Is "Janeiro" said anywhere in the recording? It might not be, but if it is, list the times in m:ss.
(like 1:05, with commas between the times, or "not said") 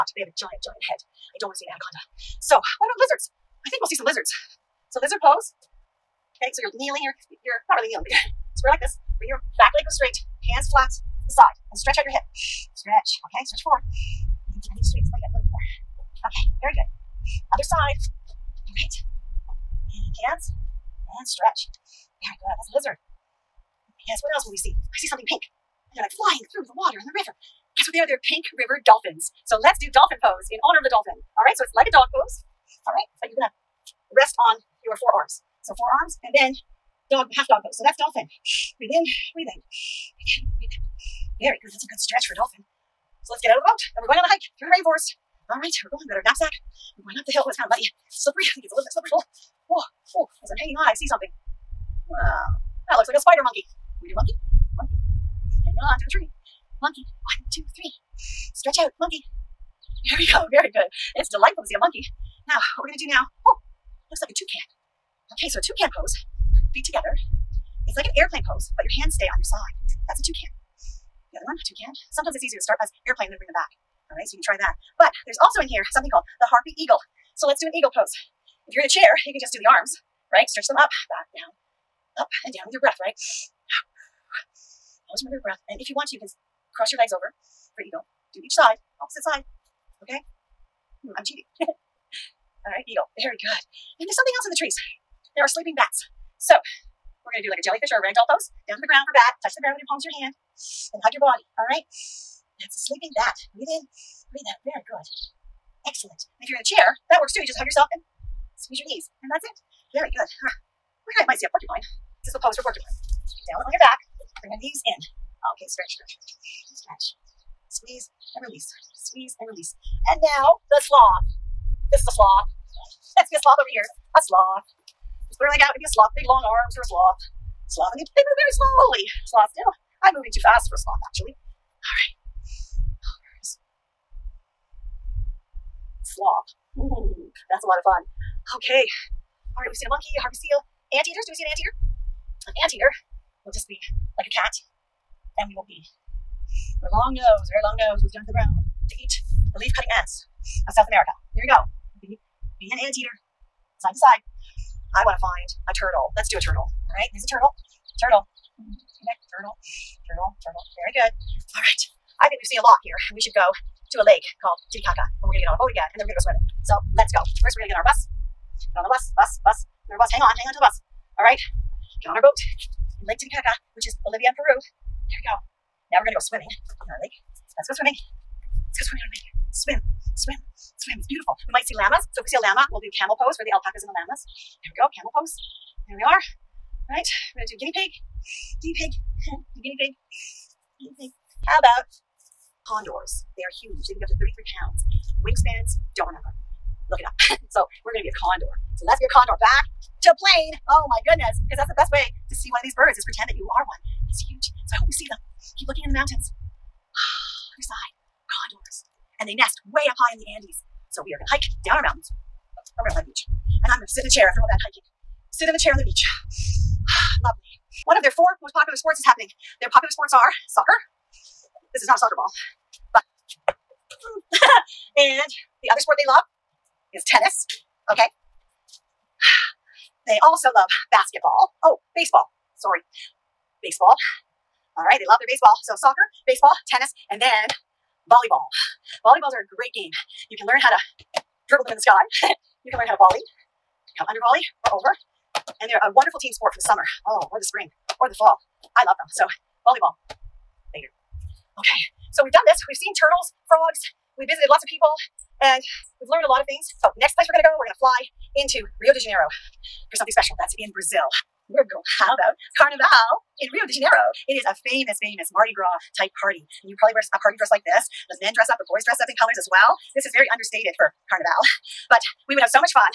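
4:18, 4:23.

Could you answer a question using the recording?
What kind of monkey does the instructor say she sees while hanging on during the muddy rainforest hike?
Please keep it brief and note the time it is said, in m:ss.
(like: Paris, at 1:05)
spider monkey, at 0:53.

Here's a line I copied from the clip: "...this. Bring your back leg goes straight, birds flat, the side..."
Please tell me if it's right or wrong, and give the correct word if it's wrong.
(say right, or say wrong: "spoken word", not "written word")
wrong: "hands", not "birds".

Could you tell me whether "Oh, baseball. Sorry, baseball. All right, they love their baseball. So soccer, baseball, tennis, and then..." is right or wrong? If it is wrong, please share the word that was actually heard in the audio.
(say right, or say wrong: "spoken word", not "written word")
right.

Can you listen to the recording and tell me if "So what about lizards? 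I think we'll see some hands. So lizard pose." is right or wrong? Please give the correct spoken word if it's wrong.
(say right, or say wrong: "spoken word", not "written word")
wrong: "lizards", not "hands".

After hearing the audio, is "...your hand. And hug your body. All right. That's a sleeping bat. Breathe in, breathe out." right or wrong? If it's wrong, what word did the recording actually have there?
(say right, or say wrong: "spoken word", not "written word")
right.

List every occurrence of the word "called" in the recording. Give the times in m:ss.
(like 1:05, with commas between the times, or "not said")
1:16, 2:44.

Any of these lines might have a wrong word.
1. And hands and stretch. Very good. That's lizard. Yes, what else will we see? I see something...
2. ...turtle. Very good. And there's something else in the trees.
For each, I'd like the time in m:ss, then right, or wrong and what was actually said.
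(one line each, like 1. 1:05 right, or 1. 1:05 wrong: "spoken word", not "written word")
1. 0:19 right
2. 1:32 wrong: "eagle", not "turtle".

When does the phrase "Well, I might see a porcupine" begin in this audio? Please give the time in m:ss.
1:51.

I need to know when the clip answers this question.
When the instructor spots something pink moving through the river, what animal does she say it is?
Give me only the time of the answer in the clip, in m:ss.
0:28.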